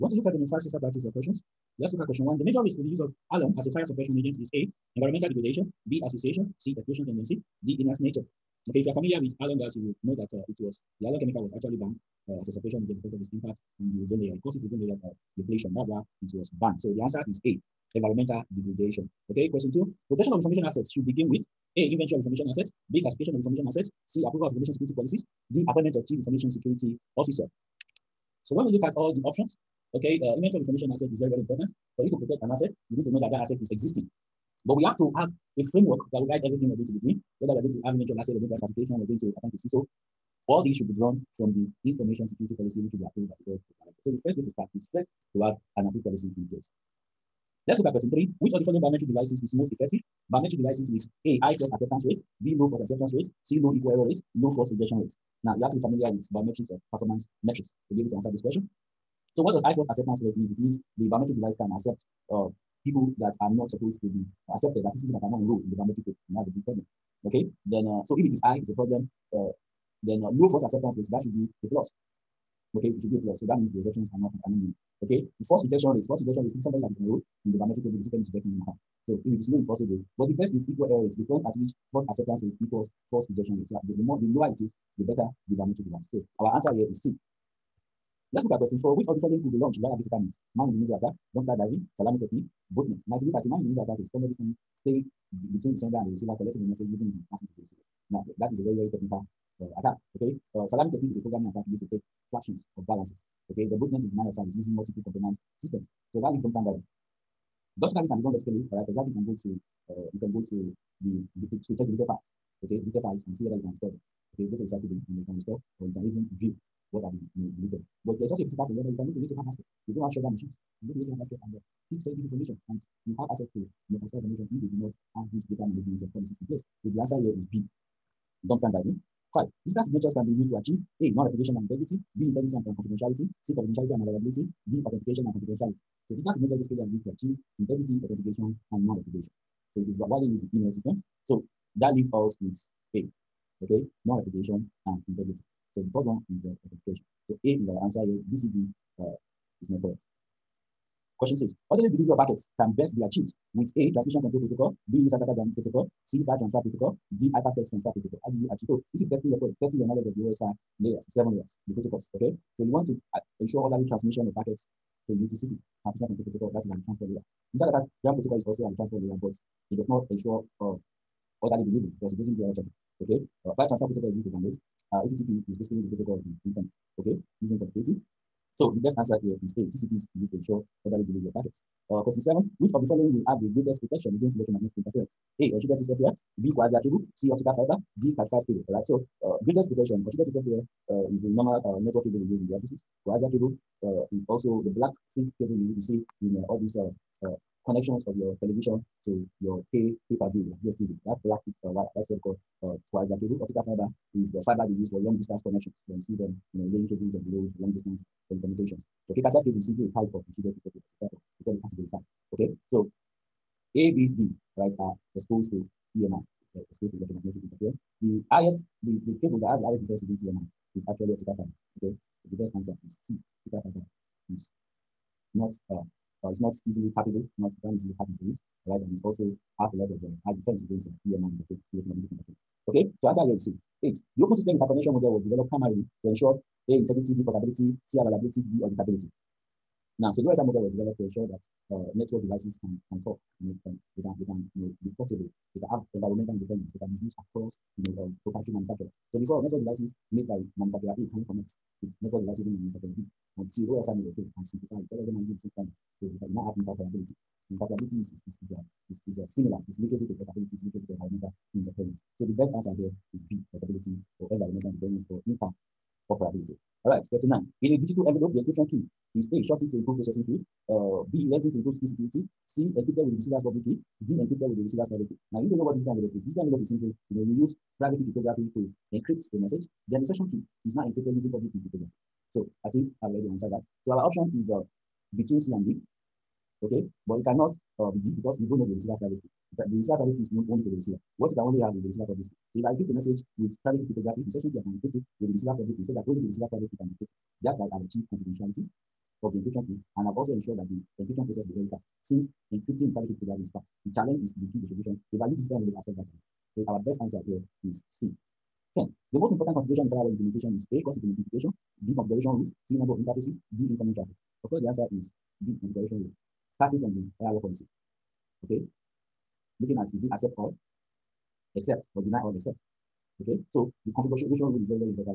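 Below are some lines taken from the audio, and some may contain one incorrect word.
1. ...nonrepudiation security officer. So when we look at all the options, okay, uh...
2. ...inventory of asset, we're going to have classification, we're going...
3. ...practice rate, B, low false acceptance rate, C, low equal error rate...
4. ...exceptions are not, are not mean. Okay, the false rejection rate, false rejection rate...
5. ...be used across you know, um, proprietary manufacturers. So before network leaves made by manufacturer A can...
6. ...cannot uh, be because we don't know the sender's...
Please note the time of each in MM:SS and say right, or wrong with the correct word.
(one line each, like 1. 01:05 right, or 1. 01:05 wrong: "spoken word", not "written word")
1. 00:26 wrong: "information", not "nonrepudiation"
2. 00:37 right
3. 00:51 wrong: "acceptance", not "practice"
4. 01:13 right
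5. 04:06 wrong: "devices", not "leaves"
6. 04:47 wrong: "receiver", not "sender".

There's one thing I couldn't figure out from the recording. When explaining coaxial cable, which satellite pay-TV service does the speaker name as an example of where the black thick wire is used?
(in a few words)
DSTV.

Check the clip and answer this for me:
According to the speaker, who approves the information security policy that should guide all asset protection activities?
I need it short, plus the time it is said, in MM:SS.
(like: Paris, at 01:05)
board of directors, at 00:43.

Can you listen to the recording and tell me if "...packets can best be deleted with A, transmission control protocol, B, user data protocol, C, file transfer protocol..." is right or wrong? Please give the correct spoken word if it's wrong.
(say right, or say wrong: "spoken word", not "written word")
wrong: "achieved", not "deleted".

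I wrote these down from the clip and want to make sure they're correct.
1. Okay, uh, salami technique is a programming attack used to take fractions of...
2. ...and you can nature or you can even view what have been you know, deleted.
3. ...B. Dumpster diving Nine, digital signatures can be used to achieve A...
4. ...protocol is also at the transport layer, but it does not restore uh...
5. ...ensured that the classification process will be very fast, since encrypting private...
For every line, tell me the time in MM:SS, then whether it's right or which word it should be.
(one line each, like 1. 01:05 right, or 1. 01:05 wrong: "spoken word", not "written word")
1. 01:40 right
2. 01:55 wrong: "restore", not "nature"
3. 02:07 wrong: "Five", not "Nine"
4. 02:48 wrong: "ensure", not "restore"
5. 05:00 wrong: "encryption", not "classification".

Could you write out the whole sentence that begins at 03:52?
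Okay, so answer here is C.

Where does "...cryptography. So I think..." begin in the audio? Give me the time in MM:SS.
04:41.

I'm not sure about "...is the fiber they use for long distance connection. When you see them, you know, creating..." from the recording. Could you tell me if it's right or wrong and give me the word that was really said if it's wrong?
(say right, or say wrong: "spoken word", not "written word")
wrong: "laying", not "creating".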